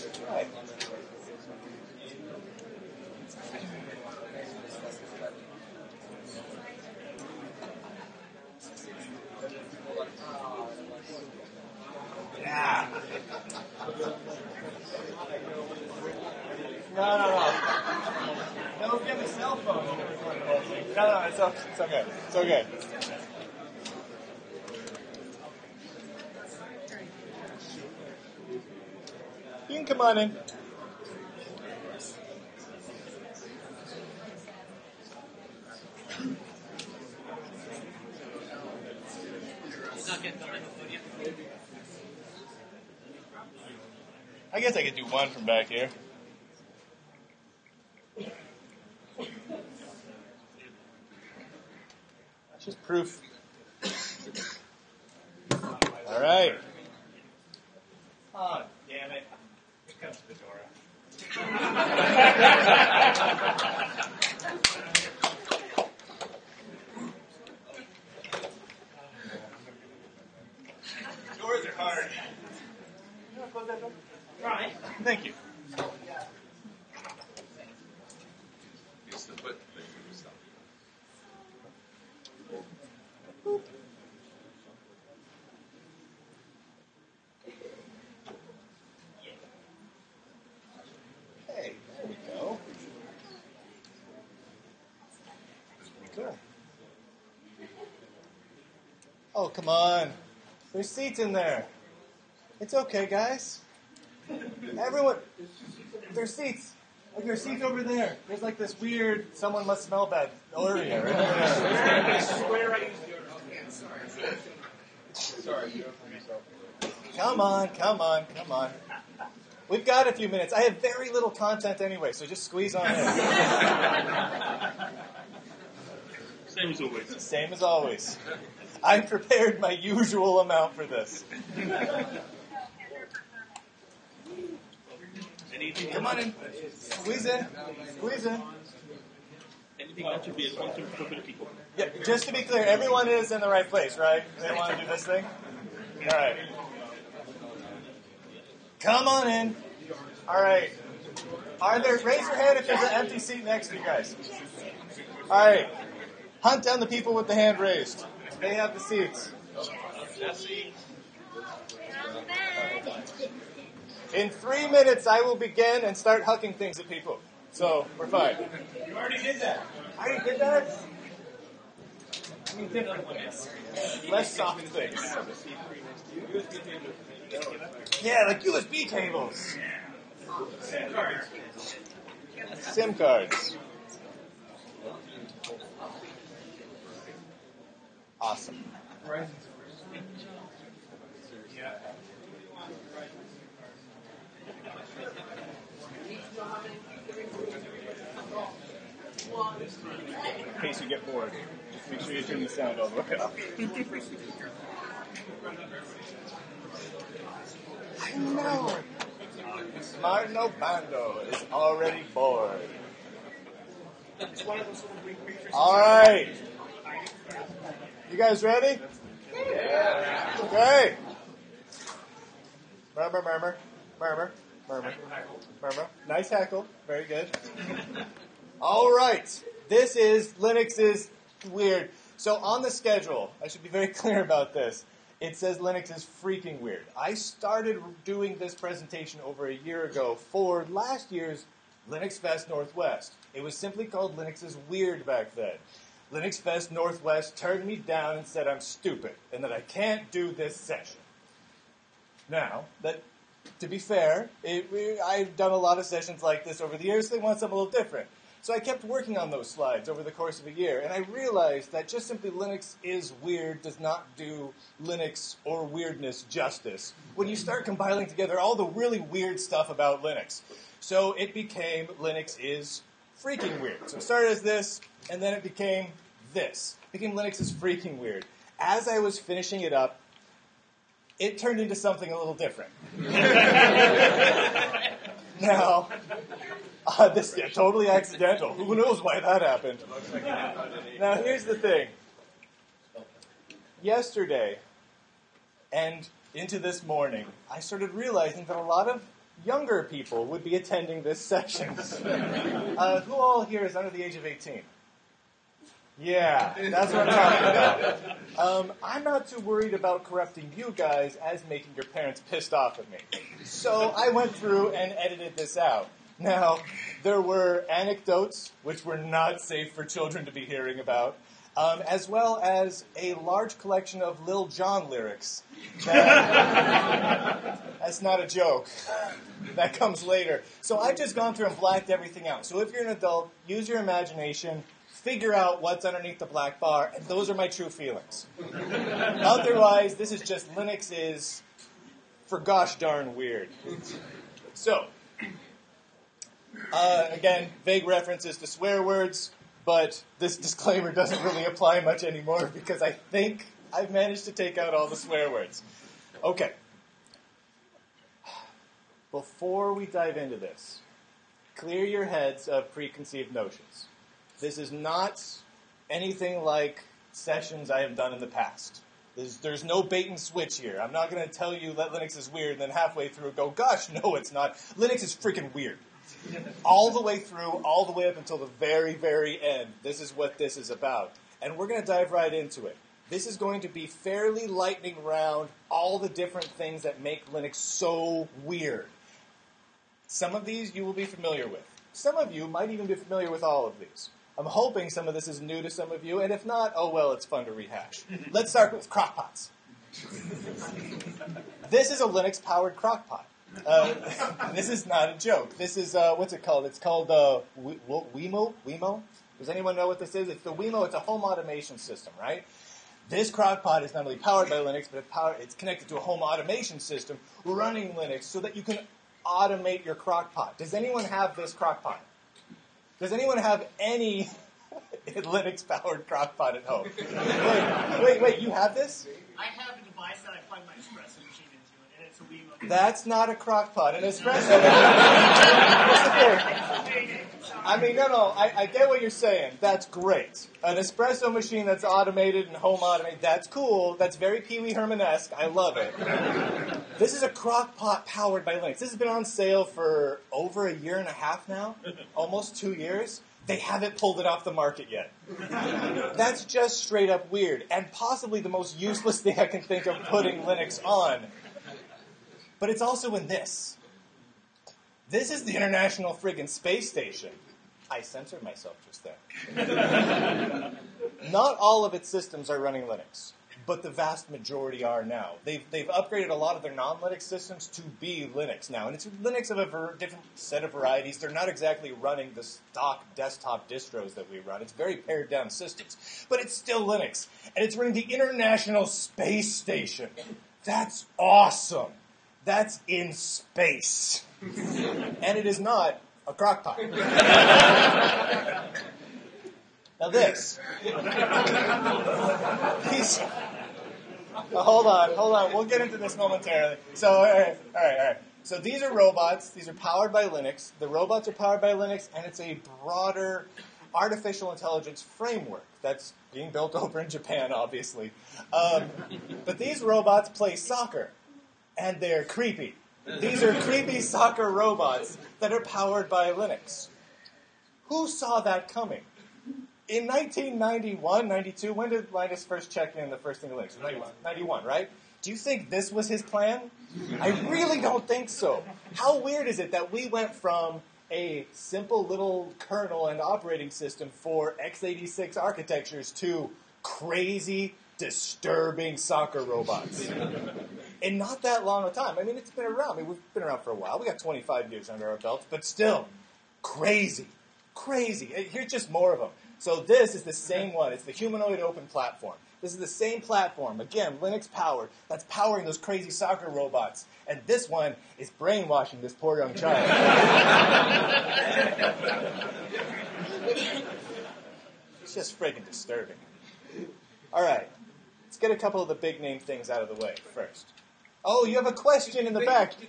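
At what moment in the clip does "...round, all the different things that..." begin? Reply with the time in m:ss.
6:25.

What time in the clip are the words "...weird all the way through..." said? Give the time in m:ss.
6:15.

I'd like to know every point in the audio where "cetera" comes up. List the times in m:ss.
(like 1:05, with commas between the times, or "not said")
not said.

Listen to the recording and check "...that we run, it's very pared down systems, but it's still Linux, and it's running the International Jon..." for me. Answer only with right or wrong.
wrong.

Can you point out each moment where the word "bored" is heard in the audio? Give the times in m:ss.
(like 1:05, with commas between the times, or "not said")
3:21, 3:32.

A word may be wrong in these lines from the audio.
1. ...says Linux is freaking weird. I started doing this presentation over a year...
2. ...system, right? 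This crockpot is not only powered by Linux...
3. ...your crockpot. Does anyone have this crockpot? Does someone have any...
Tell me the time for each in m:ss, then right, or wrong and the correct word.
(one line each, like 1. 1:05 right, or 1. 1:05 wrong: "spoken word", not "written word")
1. 3:55 right
2. 6:51 right
3. 6:59 wrong: "anyone", not "someone".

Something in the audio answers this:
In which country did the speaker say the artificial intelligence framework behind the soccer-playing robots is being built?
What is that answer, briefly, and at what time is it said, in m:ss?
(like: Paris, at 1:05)
Japan, at 8:37.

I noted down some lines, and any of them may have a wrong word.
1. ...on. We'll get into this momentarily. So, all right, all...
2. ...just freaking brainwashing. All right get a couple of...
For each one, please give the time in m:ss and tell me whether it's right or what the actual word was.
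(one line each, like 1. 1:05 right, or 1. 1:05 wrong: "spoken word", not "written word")
1. 8:25 right
2. 9:35 wrong: "disturbing", not "brainwashing".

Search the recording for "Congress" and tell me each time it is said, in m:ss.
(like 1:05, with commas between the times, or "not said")
not said.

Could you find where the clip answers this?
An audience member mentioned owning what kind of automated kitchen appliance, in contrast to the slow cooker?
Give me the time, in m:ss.
7:20.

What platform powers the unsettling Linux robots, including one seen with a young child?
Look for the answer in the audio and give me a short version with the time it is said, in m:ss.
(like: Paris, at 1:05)
Humanoid open platform, at 9:21.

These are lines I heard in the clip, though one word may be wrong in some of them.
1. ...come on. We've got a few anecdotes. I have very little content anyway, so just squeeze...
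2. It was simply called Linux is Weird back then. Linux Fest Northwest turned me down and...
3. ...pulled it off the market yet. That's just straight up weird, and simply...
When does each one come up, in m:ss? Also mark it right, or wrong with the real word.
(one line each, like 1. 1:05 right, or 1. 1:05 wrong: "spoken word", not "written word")
1. 1:58 wrong: "minutes", not "anecdotes"
2. 4:03 right
3. 7:33 wrong: "possibly", not "simply".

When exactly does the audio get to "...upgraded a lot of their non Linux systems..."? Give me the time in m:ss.
7:55.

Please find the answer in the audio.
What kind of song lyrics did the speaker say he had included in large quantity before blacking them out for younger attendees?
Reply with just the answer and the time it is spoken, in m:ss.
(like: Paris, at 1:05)
Lil Jon lyrics, at 5:24.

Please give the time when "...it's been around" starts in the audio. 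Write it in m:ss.
9:12.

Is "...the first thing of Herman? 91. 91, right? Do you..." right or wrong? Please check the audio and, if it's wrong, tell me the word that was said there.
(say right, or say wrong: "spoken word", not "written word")
wrong: "Linux", not "Herman".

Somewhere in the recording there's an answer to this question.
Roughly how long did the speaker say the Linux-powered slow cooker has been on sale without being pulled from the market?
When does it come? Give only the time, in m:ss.
7:30.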